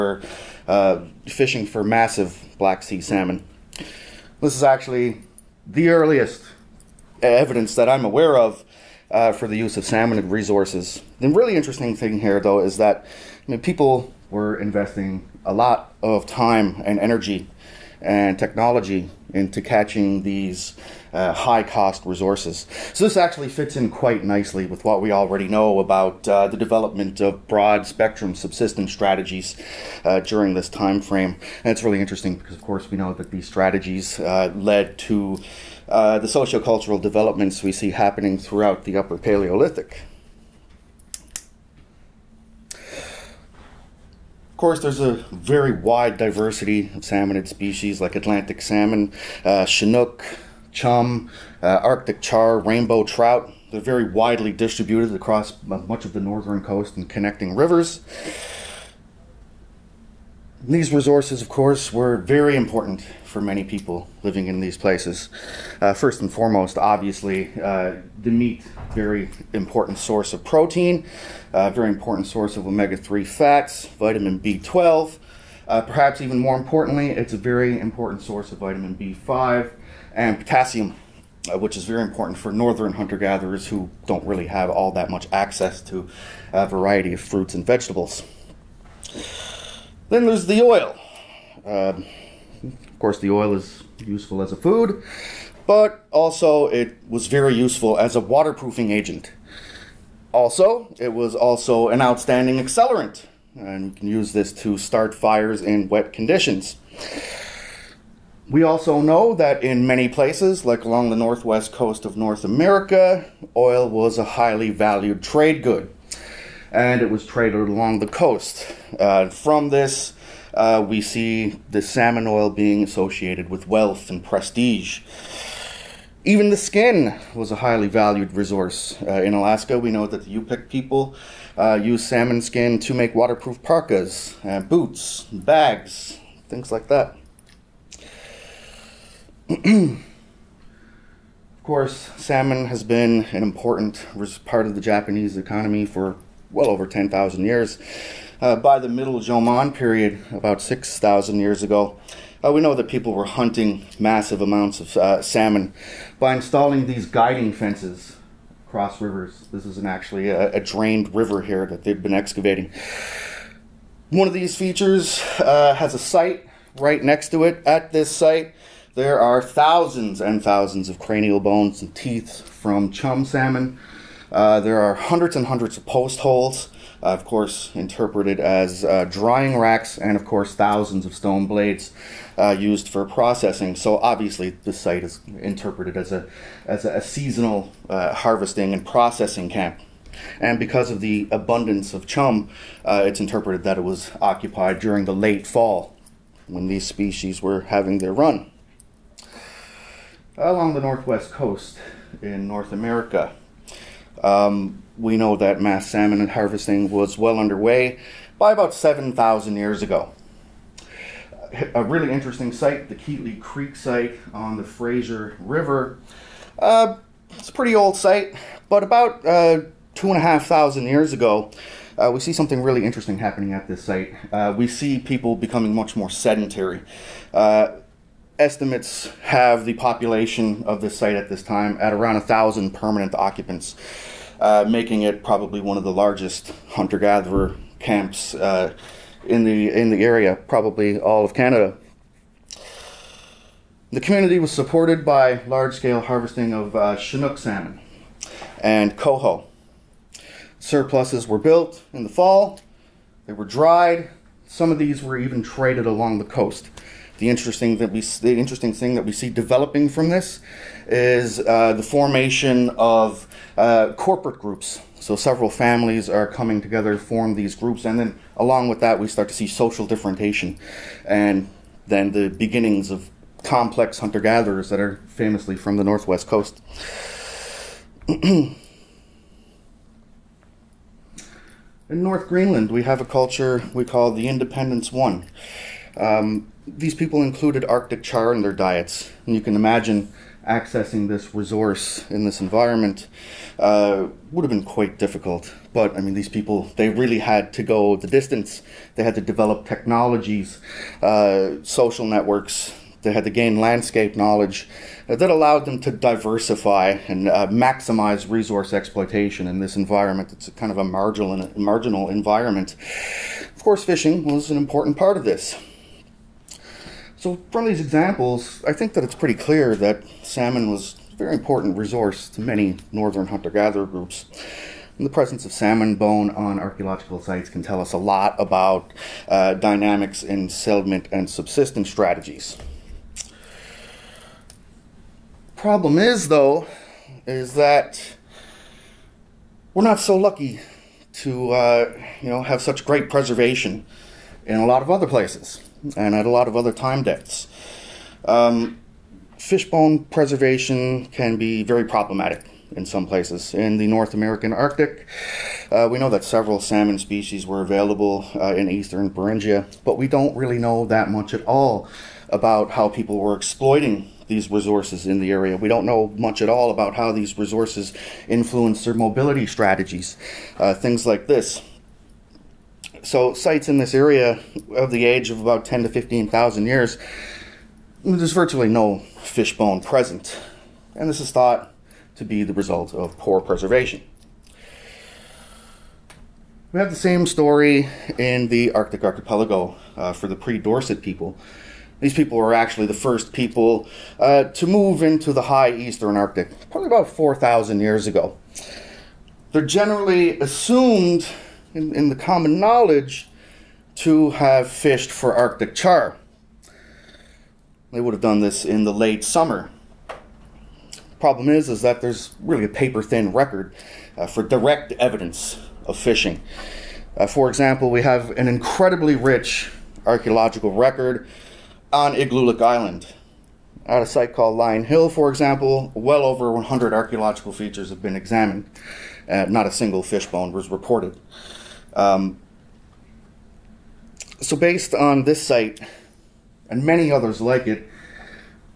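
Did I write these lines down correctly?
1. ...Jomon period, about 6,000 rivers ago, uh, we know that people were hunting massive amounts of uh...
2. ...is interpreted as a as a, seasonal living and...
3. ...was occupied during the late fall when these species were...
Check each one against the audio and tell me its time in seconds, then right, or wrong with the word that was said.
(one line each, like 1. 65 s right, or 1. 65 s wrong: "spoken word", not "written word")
1. 149 s wrong: "years", not "rivers"
2. 185 s wrong: "harvesting", not "living"
3. 193 s right.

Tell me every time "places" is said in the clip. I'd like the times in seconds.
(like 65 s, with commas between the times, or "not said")
64 s, 110 s, 345 s, 353 s.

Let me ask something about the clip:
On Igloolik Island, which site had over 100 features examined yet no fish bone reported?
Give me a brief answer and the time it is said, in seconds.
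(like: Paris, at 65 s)
Lyon Hill, at 424 s.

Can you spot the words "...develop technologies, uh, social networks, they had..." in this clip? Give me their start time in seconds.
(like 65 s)
299 s.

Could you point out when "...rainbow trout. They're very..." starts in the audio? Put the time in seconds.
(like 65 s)
52 s.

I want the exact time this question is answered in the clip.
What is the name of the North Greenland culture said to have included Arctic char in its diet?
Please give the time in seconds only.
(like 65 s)
284 s.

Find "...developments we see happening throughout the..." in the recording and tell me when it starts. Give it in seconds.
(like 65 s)
37 s.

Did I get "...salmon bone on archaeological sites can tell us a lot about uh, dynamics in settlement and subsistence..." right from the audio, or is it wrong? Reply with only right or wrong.
right.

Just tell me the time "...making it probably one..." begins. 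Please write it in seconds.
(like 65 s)
234 s.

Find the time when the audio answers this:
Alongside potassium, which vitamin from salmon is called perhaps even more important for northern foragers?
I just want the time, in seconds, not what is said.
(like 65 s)
78 s.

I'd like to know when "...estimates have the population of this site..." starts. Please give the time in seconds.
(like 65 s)
228 s.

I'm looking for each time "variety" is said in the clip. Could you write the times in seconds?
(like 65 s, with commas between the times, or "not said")
86 s.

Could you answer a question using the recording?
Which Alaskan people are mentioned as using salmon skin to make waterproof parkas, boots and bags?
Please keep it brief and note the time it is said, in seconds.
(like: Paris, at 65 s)
Yupik, at 130 s.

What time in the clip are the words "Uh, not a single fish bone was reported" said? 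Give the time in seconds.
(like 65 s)
429 s.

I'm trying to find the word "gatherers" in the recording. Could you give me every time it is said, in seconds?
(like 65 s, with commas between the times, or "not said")
83 s, 236 s, 274 s, 323 s.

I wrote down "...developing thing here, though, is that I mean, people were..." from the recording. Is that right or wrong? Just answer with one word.
wrong.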